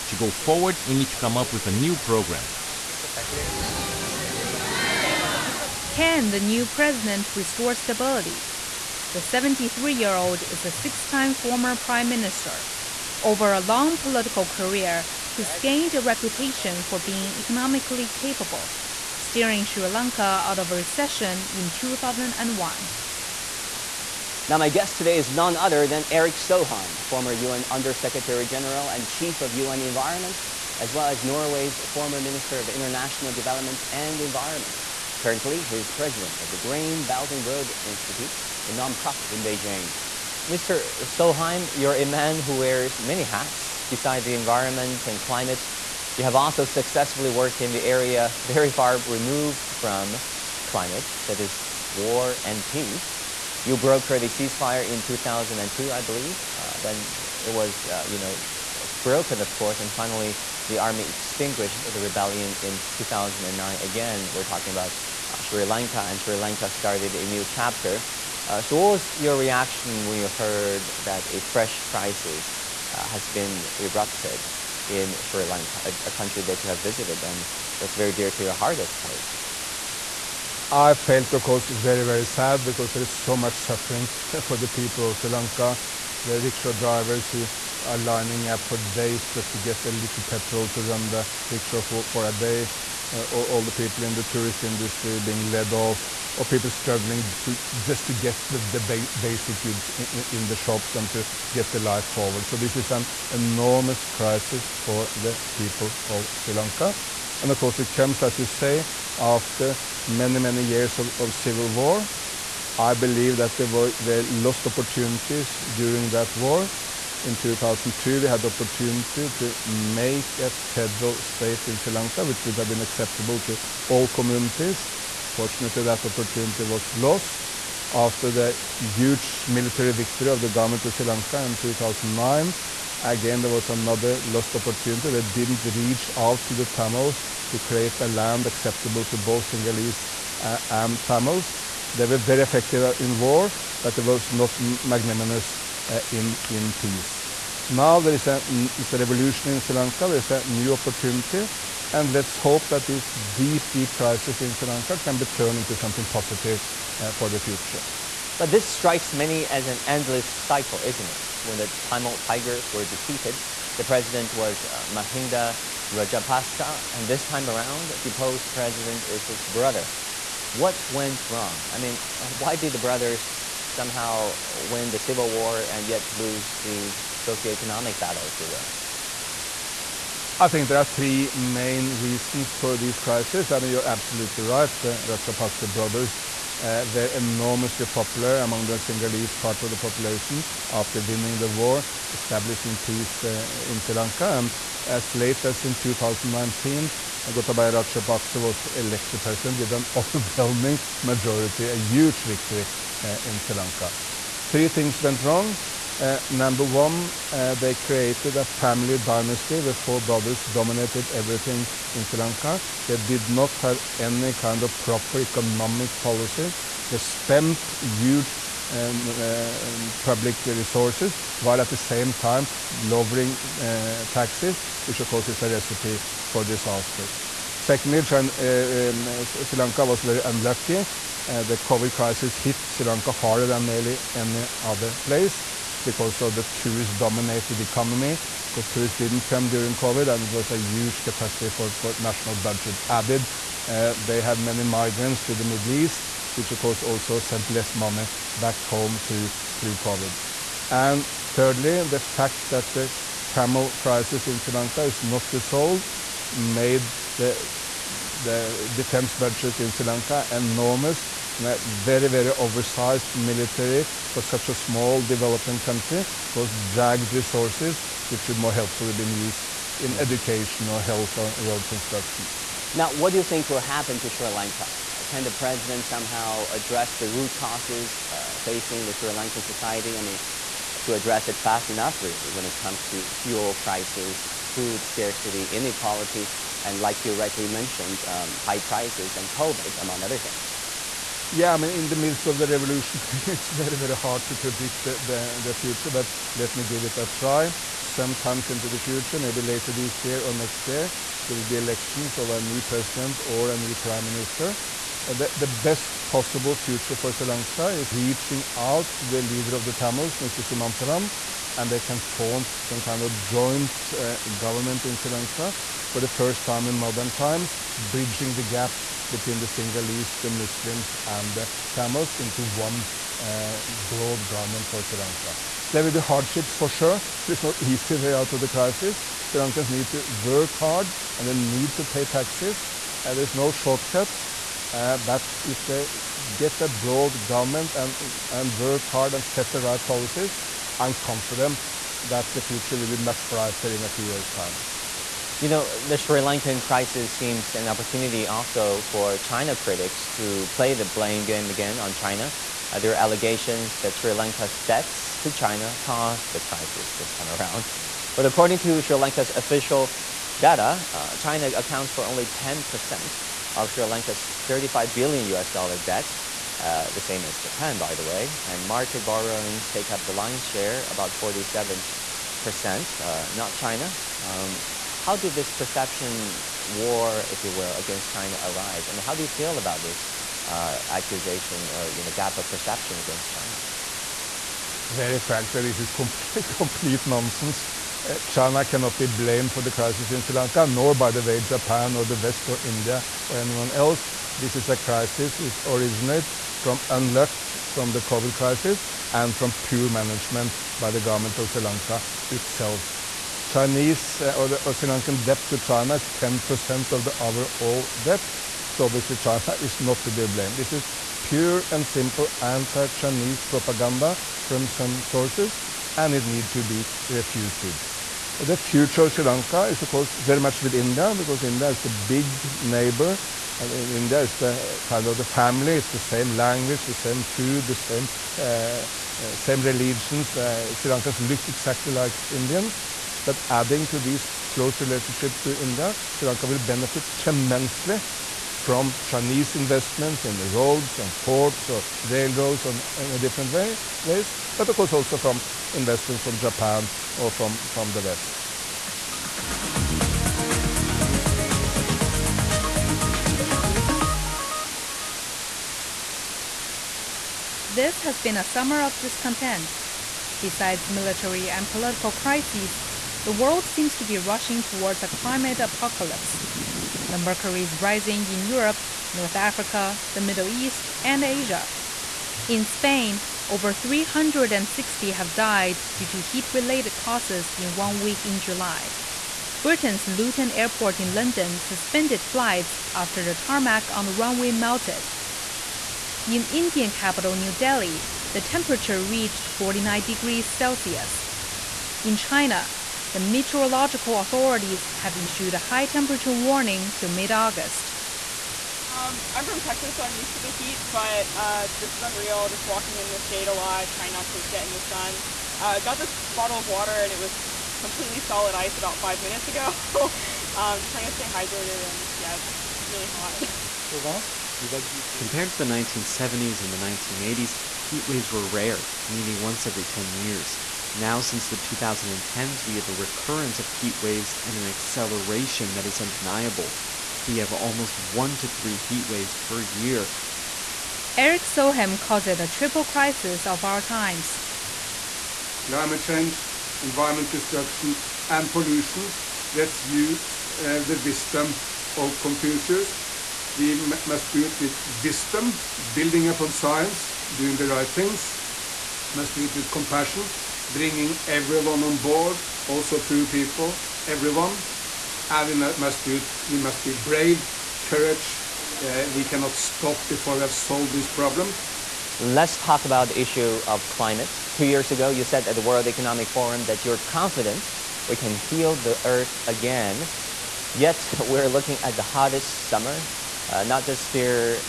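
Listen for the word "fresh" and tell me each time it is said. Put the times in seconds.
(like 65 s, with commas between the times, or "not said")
71 s.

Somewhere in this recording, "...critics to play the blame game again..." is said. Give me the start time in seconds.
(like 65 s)
349 s.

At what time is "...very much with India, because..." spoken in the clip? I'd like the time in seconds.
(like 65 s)
420 s.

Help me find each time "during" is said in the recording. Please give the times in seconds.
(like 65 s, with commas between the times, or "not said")
115 s, 239 s.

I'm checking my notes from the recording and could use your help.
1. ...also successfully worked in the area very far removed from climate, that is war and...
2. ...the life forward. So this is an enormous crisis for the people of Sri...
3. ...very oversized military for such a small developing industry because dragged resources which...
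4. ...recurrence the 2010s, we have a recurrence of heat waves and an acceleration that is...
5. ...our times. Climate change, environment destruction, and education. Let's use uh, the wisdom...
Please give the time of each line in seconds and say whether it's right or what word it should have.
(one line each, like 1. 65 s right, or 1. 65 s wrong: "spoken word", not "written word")
1. 46 s right
2. 101 s right
3. 262 s wrong: "country", not "industry"
4. 521 s wrong: "since", not "recurrence"
5. 533 s wrong: "pollution", not "education".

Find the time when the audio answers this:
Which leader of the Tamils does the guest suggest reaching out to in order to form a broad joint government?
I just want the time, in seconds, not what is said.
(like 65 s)
310 s.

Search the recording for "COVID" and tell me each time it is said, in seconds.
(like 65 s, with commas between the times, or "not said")
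231 s, 239 s, 249 s, 289 s, 398 s.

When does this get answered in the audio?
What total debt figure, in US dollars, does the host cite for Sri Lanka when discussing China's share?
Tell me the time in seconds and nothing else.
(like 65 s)
364 s.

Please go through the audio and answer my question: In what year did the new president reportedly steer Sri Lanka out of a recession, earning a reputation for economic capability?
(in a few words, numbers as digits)
2001.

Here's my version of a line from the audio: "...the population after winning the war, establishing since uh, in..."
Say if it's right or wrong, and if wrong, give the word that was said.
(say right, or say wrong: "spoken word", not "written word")
wrong: "peace", not "since".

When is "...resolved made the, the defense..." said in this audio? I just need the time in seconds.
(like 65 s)
255 s.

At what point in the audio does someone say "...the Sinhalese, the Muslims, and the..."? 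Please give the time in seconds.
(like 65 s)
319 s.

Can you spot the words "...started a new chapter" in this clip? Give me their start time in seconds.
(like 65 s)
66 s.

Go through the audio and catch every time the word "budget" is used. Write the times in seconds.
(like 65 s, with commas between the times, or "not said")
242 s, 259 s.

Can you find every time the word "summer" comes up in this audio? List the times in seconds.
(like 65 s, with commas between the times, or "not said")
458 s, 572 s.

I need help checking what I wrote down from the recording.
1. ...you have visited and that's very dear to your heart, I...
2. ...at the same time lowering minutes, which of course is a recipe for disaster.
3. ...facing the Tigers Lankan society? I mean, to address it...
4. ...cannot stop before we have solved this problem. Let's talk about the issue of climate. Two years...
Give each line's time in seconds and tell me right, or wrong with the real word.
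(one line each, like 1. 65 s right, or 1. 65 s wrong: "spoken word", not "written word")
1. 76 s right
2. 221 s wrong: "taxes", not "minutes"
3. 278 s wrong: "Sri", not "Tigers"
4. 559 s right.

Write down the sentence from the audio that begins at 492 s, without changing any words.
In China, the meteorological authorities have issued a high temperature warning till mid August.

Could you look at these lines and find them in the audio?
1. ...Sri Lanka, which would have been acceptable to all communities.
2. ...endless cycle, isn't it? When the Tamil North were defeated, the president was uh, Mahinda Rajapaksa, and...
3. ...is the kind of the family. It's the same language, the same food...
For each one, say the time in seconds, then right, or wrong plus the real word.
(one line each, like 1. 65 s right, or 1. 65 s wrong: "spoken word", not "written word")
1. 121 s right
2. 159 s wrong: "Tigers", not "North"
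3. 424 s right.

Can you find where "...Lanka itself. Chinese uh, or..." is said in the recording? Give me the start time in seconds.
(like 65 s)
401 s.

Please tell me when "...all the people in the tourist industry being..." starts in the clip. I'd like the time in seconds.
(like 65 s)
93 s.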